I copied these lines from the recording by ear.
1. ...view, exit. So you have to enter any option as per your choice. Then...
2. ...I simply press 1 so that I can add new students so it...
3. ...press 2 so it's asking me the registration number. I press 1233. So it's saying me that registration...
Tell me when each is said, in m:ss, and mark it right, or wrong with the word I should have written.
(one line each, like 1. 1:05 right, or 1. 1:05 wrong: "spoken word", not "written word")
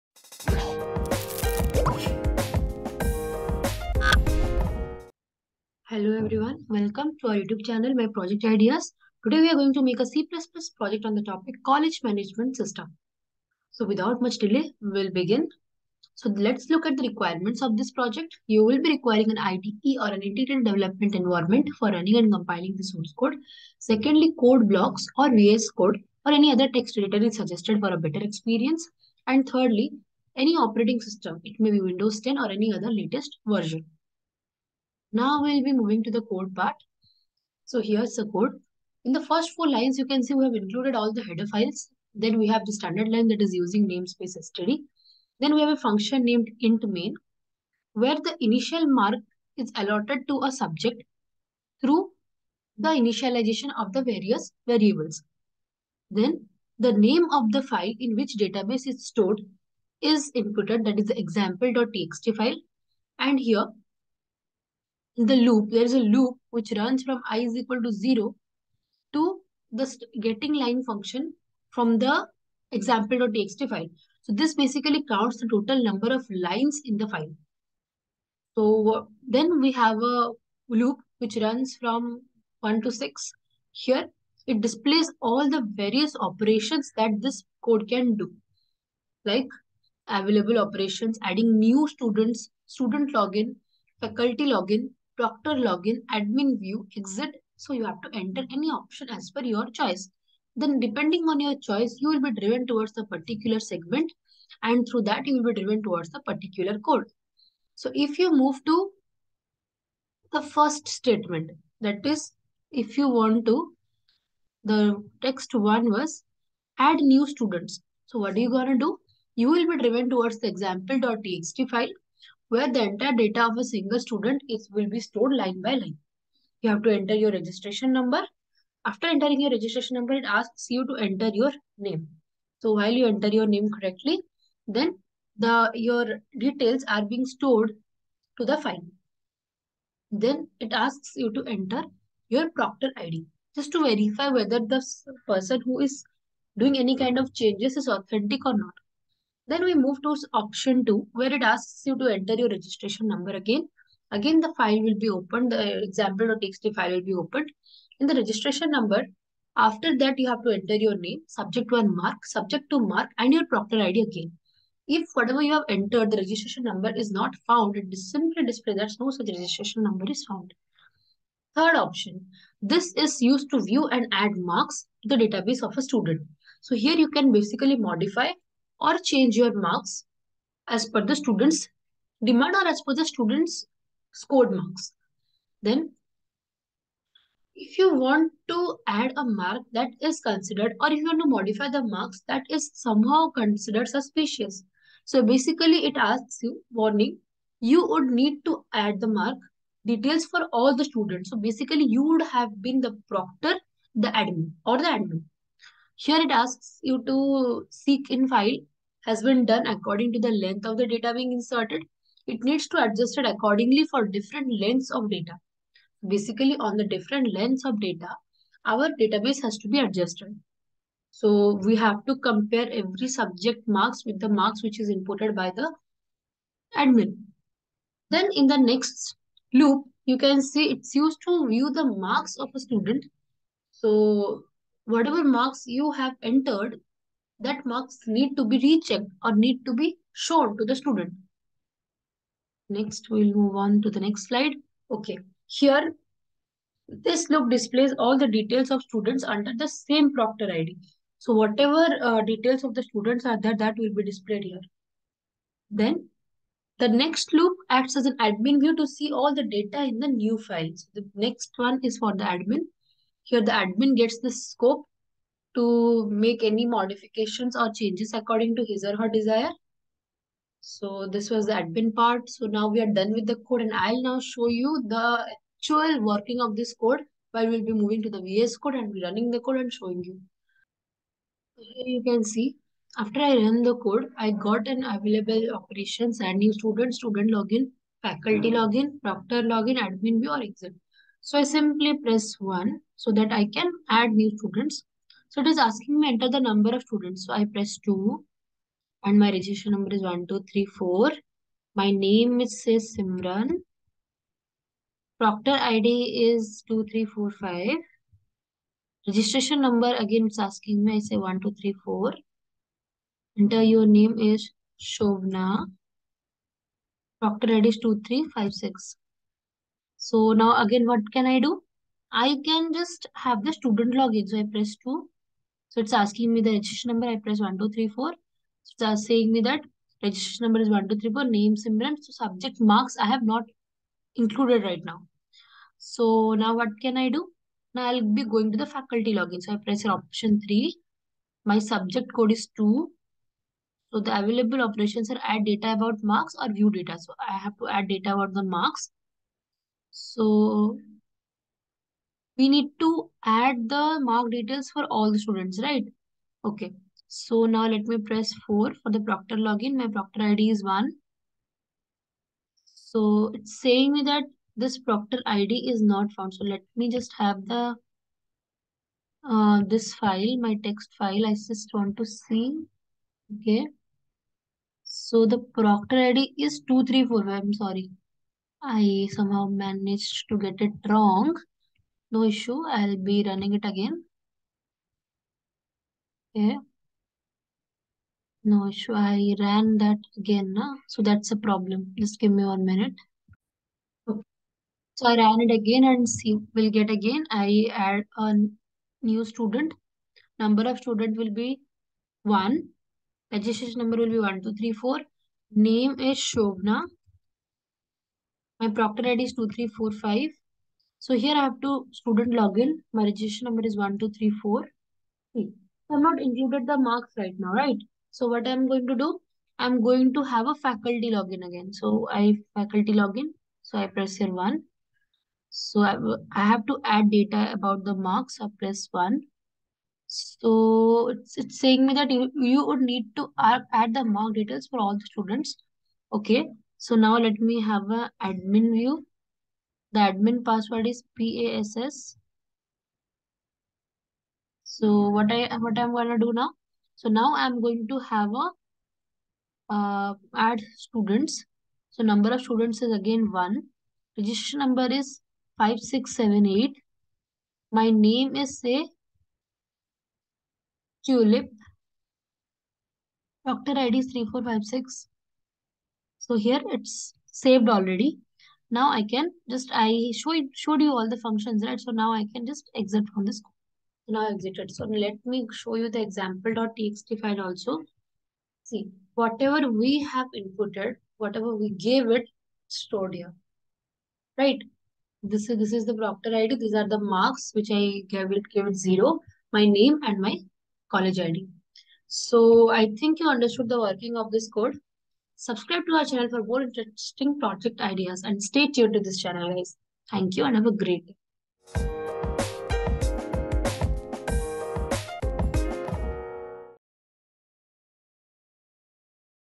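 1. 1:36 right
2. 4:51 right
3. 5:24 wrong: "1234", not "1233".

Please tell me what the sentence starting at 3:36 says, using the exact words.
Basically, on the different lengths of data, our database has to be adjusted.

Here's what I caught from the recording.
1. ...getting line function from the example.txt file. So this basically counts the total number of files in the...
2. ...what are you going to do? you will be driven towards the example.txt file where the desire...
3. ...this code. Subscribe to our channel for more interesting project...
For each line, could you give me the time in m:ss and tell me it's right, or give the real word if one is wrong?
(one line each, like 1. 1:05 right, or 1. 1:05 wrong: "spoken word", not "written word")
1. 1:10 wrong: "lines", not "files"
2. 1:58 wrong: "entire", not "desire"
3. 8:14 right.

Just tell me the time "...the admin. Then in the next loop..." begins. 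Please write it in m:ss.
3:45.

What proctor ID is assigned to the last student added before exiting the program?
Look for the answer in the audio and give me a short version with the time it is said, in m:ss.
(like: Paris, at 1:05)
3456, at 7:43.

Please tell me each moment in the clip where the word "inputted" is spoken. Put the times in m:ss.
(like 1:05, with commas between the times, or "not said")
1:00, 3:44, 8:00.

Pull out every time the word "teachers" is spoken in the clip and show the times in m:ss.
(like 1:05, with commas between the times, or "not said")
not said.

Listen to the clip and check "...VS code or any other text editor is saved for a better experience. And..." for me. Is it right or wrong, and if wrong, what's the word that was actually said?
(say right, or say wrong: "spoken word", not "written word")
wrong: "suggested", not "saved".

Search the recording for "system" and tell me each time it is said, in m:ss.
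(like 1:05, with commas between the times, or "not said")
0:12, 0:31.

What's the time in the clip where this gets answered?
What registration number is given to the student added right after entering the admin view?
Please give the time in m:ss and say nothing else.
7:35.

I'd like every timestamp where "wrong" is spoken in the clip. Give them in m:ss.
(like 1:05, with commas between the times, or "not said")
6:20.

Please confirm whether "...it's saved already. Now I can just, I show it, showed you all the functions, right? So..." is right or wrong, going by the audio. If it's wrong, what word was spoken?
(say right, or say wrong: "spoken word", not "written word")
right.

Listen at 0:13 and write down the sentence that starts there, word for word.
So without much delay, we'll begin.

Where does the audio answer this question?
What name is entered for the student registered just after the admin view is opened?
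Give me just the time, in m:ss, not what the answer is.
7:41.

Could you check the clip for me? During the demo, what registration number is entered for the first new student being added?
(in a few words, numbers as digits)
1234.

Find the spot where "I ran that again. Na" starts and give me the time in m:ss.
6:28.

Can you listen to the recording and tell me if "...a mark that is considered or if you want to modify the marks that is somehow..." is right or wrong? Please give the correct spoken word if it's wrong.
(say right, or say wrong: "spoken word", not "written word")
right.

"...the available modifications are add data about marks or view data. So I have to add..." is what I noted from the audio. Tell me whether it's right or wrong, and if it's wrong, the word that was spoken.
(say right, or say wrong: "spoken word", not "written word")
wrong: "operations", not "modifications".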